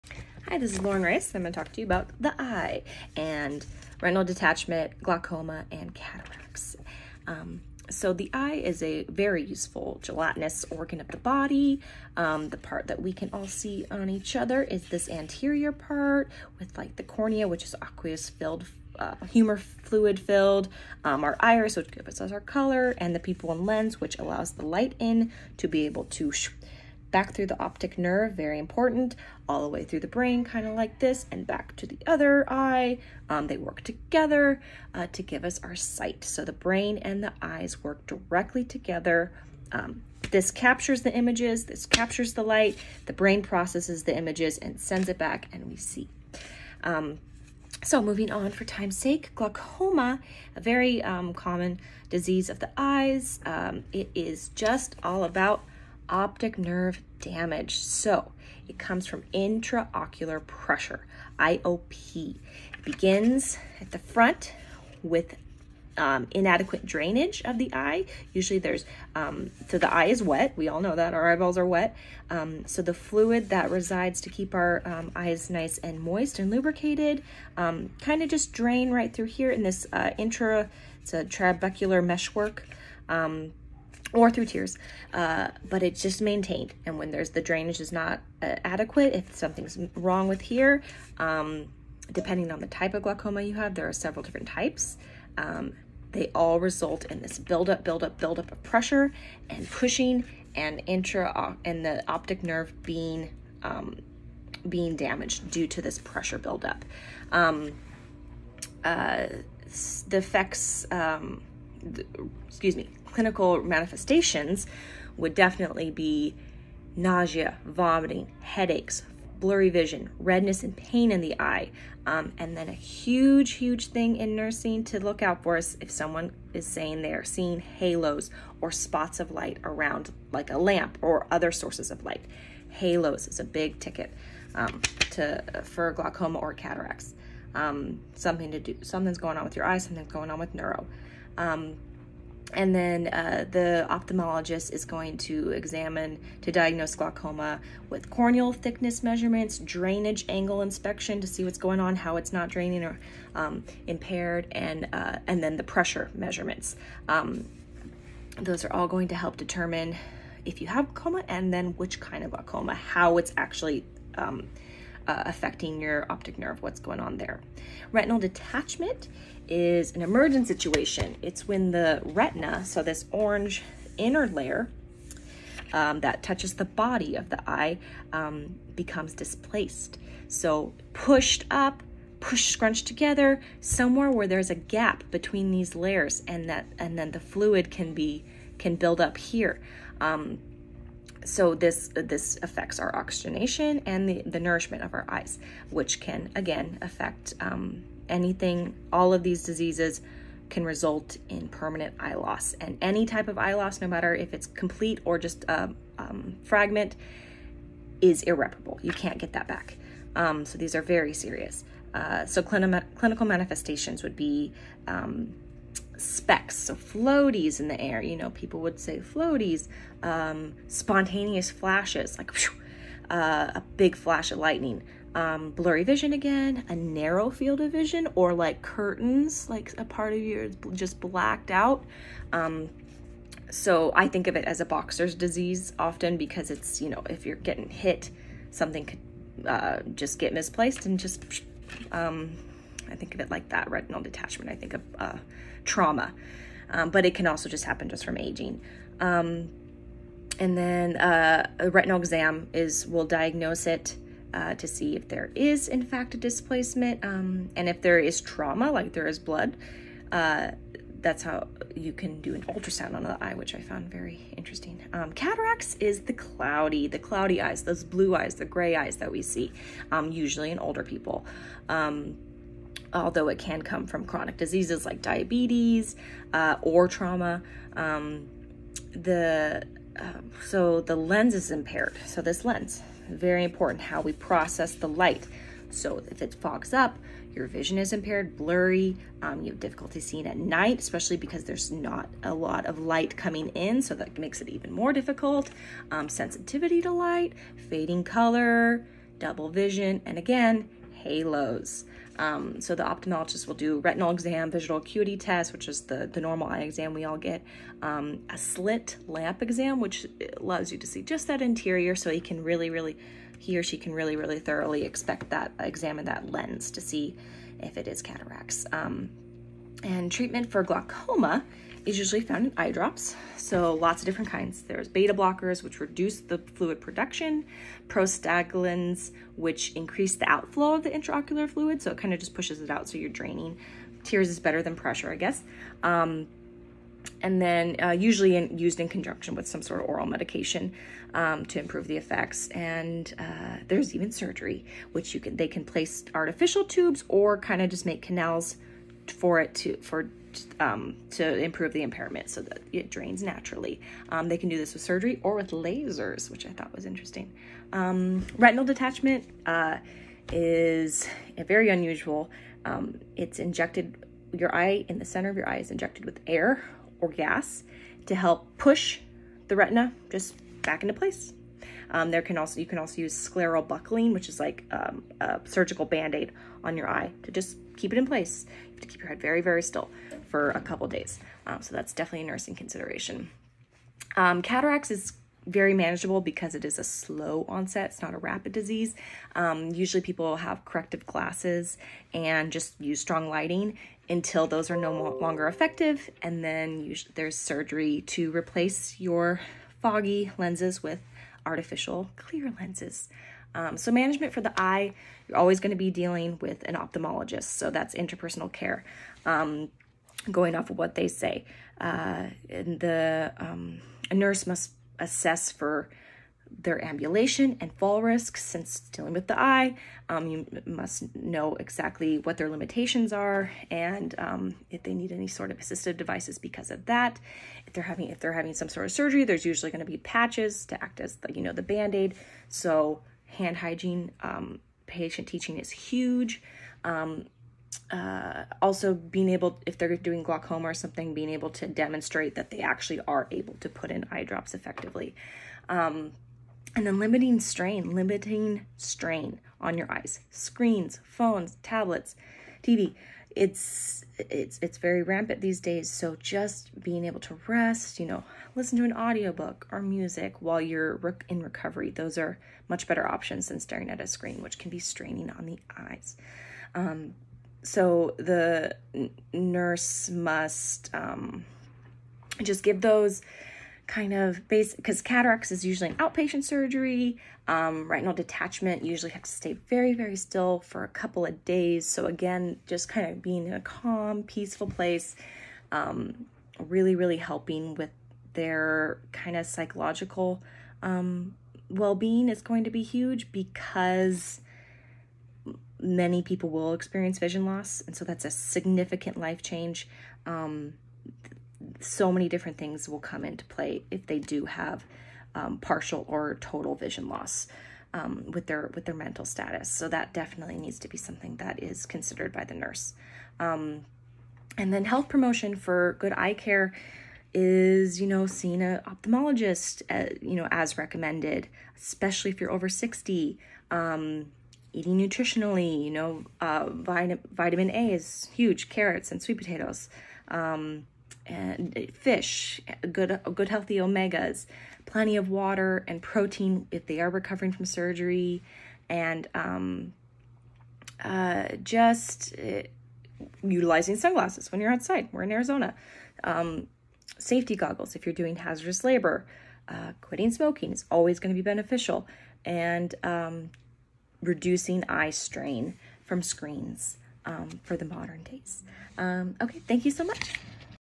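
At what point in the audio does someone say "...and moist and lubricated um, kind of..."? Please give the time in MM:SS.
01:15.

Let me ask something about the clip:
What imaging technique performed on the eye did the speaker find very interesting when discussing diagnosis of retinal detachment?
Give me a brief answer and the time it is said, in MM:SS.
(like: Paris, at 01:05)
ultrasound, at 04:22.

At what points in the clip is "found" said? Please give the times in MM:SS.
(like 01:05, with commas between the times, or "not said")
04:23, 05:22.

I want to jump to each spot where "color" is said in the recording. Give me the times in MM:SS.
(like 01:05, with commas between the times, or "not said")
00:22, 04:58.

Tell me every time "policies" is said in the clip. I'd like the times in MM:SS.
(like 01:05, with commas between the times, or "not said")
not said.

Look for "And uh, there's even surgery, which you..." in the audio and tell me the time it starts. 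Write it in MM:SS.
05:42.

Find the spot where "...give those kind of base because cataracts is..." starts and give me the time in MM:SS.
07:52.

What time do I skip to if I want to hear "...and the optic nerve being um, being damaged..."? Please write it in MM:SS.
01:41.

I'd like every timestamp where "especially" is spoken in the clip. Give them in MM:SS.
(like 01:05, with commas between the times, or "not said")
04:50, 08:41.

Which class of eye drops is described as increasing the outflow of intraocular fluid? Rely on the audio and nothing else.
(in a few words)
prostaglandins.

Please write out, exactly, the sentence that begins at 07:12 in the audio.
So hand hygiene, um, patient teaching is huge.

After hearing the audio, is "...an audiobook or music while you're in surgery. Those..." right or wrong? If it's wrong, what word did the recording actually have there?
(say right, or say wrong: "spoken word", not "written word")
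wrong: "recovery", not "surgery".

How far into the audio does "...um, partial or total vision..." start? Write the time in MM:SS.
08:25.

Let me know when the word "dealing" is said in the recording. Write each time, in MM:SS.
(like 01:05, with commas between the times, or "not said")
06:45, 06:58.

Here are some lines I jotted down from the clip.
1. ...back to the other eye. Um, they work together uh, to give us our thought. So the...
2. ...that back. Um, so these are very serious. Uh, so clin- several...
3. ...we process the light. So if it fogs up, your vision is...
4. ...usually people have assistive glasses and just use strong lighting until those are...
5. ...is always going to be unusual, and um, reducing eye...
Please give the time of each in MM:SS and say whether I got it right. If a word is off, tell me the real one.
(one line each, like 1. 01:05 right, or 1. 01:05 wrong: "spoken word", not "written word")
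1. 00:31 wrong: "sight", not "thought"
2. 03:29 wrong: "clinical", not "several"
3. 04:44 right
4. 06:29 wrong: "corrective", not "assistive"
5. 09:10 wrong: "beneficial", not "unusual".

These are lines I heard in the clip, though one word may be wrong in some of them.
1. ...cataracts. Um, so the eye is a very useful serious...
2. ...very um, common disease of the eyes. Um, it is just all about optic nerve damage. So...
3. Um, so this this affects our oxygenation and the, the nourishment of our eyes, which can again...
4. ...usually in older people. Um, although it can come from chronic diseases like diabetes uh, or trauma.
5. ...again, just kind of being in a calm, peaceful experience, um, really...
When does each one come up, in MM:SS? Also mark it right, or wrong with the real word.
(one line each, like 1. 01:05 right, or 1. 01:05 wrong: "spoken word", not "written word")
1. 00:05 wrong: "gelatinous", not "serious"
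2. 00:50 right
3. 03:10 right
4. 04:30 right
5. 08:02 wrong: "place", not "experience".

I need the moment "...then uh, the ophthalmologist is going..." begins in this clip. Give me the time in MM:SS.
02:22.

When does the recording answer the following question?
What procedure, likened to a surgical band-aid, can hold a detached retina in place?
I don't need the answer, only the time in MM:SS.
06:13.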